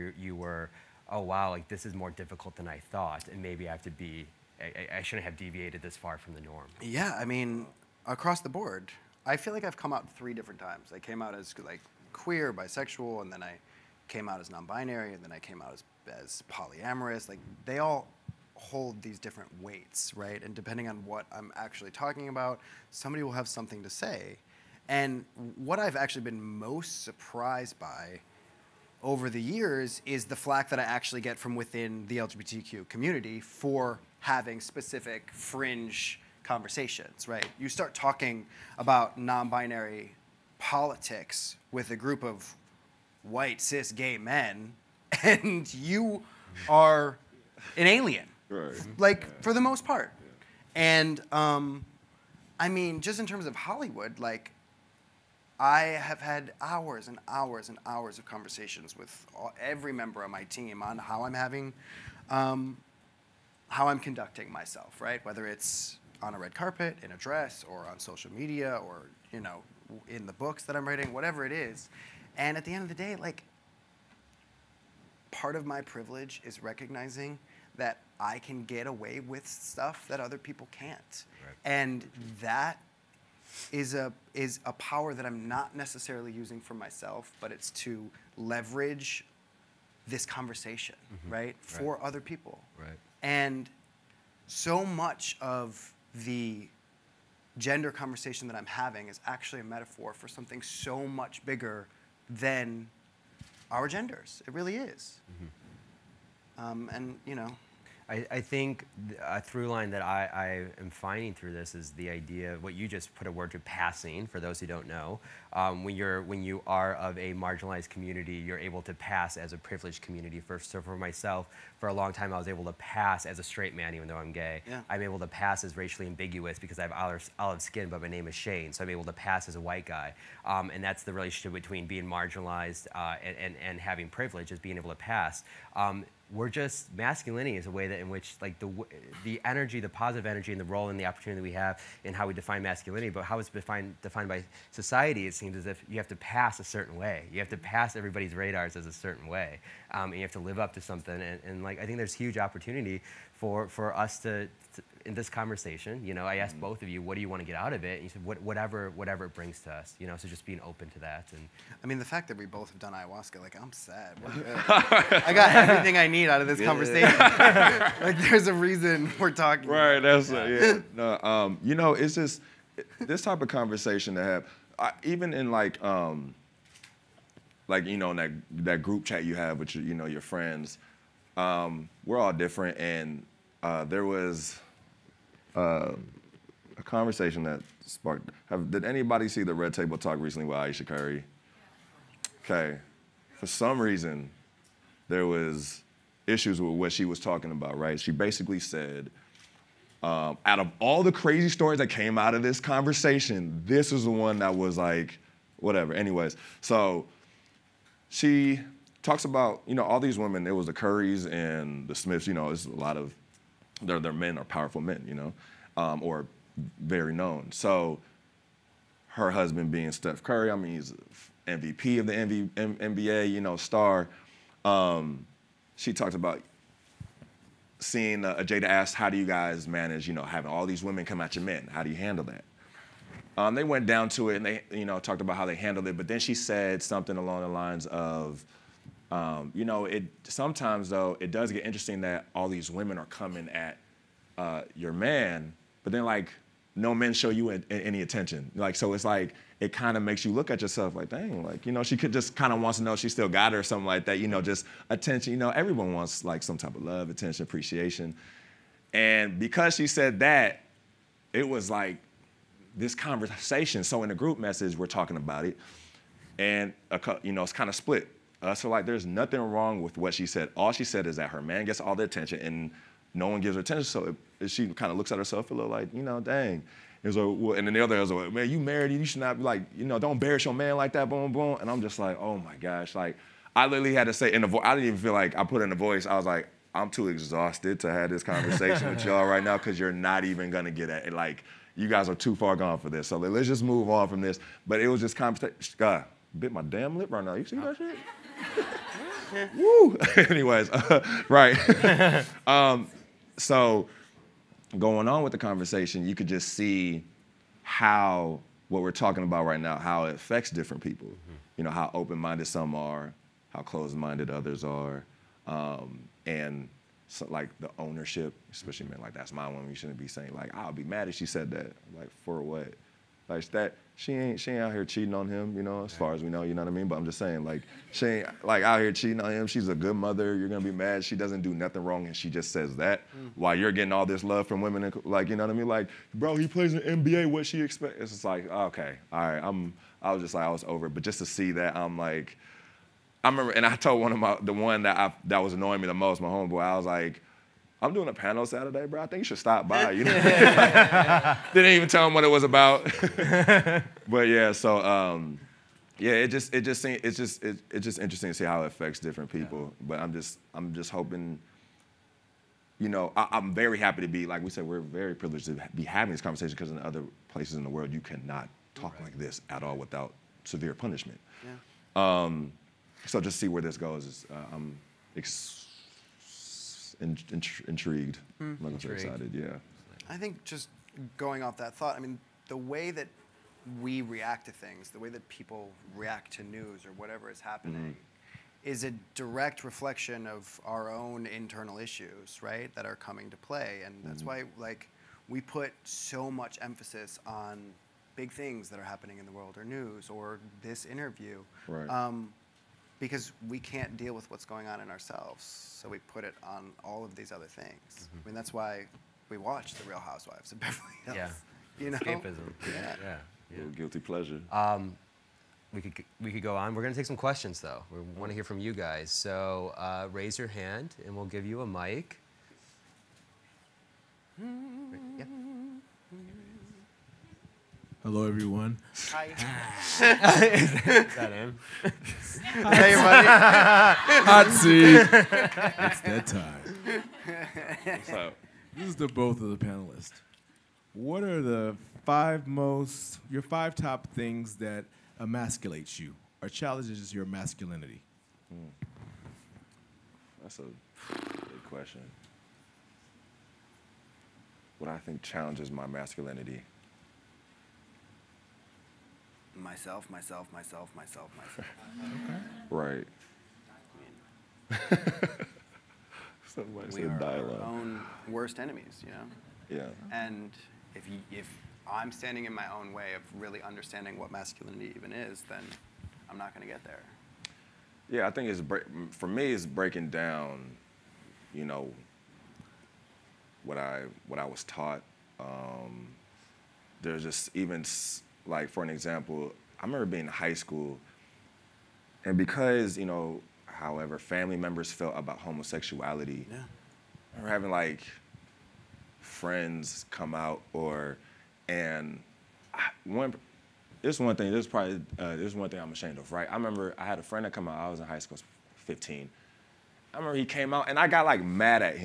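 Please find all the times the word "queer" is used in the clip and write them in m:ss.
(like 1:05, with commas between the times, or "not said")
0:12.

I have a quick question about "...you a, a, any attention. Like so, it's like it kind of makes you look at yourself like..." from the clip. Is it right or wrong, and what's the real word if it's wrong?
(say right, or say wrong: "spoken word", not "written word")
right.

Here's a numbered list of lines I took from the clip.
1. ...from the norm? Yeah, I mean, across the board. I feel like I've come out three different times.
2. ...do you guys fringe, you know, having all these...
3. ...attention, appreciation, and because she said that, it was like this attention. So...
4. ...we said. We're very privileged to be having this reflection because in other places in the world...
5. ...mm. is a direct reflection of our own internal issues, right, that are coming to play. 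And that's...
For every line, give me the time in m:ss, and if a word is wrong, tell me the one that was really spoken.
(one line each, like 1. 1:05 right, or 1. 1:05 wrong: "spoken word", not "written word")
1. 0:06 right
2. 3:49 wrong: "manage", not "fringe"
3. 4:17 wrong: "conversation", not "attention"
4. 6:04 wrong: "conversation", not "reflection"
5. 6:27 right.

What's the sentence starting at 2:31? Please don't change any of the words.
And, and like I think there's huge opportunity for for us to in this conversation, you know, I asked mm.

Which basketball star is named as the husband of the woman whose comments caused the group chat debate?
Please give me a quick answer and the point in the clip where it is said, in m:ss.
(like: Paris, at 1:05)
Steph Curry, at 3:39.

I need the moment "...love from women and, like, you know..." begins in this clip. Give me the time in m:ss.
5:34.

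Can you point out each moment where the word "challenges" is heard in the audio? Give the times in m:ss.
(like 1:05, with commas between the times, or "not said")
7:26, 7:35.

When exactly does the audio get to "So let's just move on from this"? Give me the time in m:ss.
4:53.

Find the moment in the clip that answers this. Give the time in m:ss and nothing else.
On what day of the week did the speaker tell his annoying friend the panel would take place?
5:48.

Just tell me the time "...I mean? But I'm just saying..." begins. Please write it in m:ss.
5:26.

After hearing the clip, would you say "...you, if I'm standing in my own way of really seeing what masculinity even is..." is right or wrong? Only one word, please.
wrong.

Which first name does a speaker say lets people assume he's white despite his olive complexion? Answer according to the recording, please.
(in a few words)
Shane.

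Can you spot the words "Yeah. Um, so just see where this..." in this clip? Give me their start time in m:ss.
6:11.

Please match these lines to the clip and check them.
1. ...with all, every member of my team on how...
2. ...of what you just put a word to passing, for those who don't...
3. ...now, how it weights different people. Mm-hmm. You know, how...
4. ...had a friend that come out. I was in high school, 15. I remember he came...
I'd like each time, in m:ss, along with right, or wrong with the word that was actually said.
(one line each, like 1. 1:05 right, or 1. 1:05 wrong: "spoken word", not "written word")
1. 0:58 right
2. 1:52 right
3. 5:09 wrong: "affects", not "weights"
4. 8:27 right.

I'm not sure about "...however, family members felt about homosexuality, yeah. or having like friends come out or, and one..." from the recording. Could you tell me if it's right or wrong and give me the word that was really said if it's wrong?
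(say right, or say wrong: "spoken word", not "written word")
right.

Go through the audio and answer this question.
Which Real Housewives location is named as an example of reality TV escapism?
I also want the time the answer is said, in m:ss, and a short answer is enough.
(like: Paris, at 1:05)
Beverly Hills, at 6:50.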